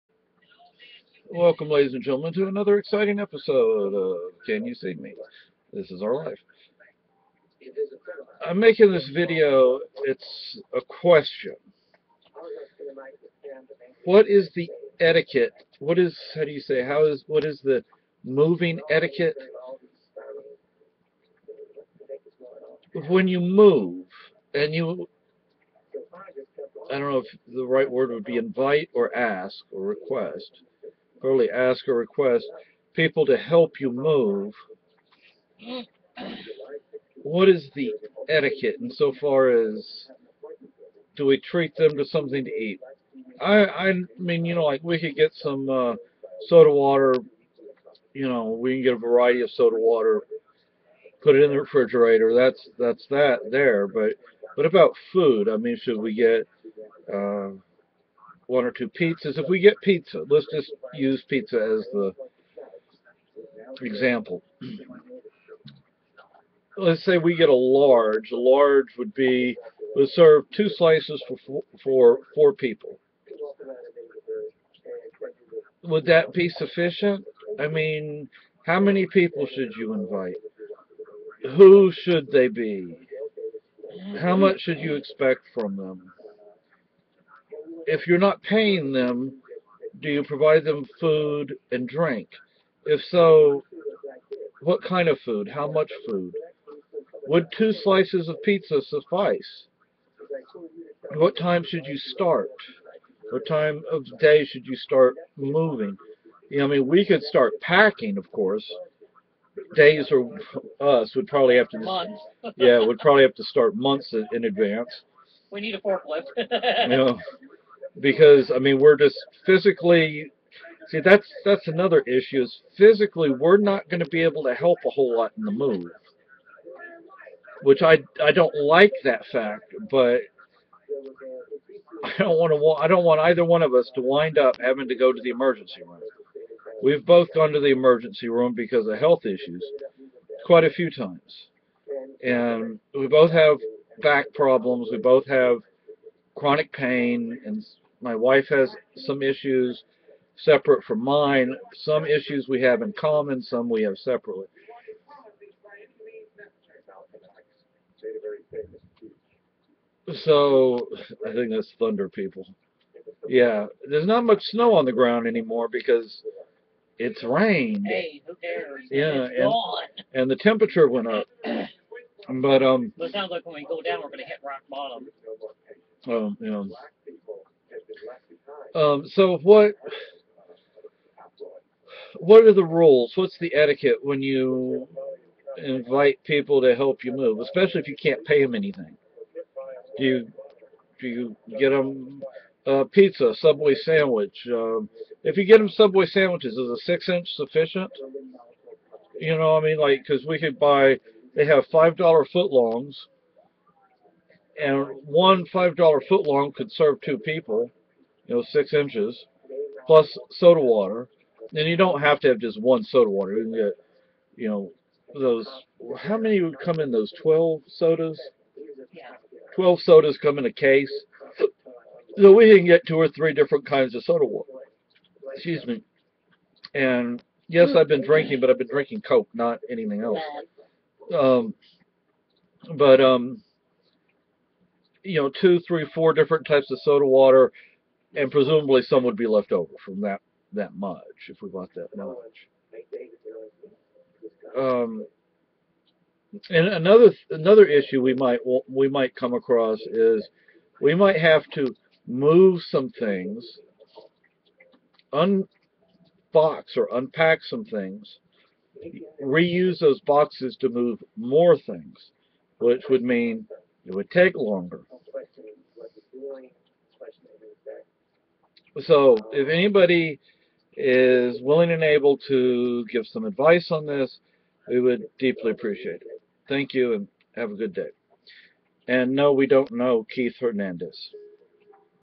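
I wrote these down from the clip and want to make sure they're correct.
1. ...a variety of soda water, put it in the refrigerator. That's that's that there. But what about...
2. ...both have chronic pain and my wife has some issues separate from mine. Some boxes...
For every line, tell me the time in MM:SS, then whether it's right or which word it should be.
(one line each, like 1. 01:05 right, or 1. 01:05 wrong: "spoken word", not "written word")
1. 00:48 right
2. 02:24 wrong: "issues", not "boxes".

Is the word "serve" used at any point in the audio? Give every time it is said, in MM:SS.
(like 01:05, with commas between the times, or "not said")
01:10, 03:26.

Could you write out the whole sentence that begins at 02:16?
We've both gone to the emergency room because of health issues quite a few times.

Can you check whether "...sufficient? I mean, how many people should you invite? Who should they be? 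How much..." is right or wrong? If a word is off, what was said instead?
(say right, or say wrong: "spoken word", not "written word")
right.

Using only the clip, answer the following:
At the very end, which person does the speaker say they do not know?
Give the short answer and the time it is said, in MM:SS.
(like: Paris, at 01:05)
Keith Hernandez, at 04:40.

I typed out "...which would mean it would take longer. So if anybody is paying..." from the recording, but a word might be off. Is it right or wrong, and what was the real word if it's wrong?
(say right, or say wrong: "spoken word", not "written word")
wrong: "willing", not "paying".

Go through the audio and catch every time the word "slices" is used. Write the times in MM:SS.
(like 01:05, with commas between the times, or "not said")
01:10, 01:37.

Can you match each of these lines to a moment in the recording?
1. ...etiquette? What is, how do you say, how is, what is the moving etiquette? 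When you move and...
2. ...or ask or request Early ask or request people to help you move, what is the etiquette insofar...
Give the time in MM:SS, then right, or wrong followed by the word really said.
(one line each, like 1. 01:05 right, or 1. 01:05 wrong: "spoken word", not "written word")
1. 00:14 right
2. 00:28 right.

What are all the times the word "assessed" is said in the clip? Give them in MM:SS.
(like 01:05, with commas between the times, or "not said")
not said.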